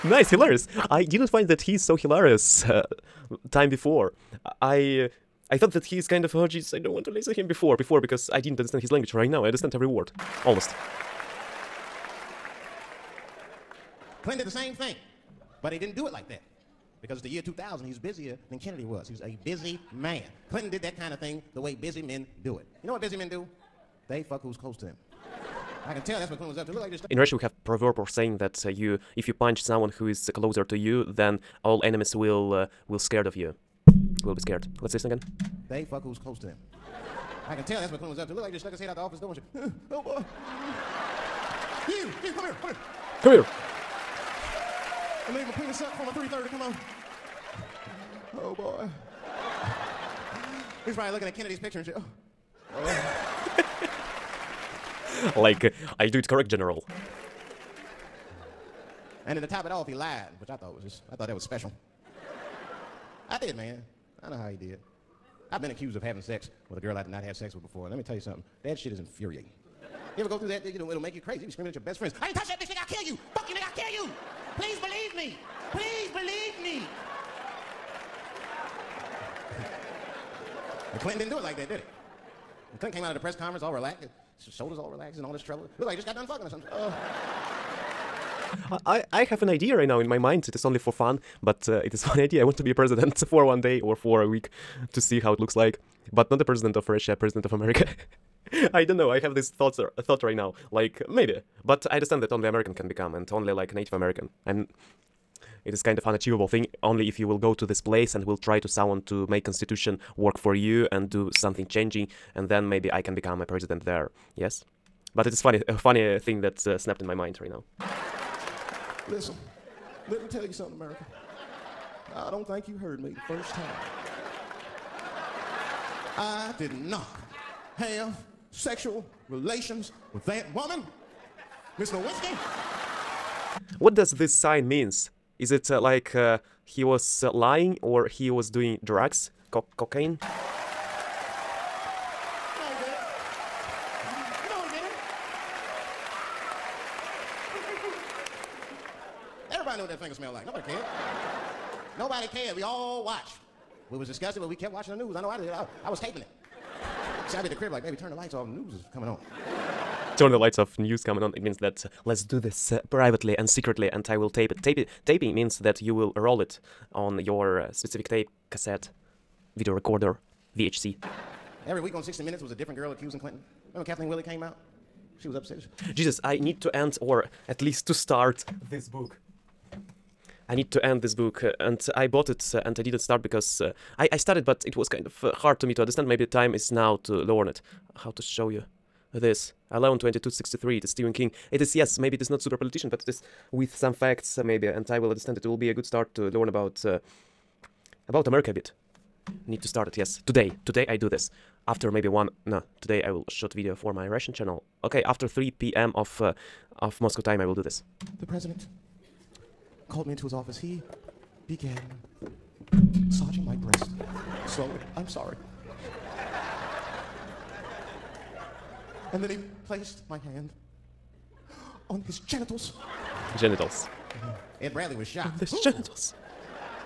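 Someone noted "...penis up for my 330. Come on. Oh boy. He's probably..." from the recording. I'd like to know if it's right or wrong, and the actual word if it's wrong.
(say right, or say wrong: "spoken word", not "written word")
right.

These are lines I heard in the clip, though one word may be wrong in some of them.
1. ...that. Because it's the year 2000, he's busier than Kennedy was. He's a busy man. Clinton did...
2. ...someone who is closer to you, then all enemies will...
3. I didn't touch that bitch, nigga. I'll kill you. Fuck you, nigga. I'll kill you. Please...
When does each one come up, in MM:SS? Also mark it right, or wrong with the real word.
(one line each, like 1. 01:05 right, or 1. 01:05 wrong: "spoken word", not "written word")
1. 00:16 right
2. 00:29 right
3. 01:12 right.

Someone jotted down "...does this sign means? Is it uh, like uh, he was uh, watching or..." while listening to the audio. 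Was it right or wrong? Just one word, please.
wrong.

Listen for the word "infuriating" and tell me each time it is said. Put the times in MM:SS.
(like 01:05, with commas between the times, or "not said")
01:08.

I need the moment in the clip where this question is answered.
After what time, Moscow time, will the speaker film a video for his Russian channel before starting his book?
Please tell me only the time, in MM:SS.
03:25.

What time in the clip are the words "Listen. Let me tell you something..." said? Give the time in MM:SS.
01:59.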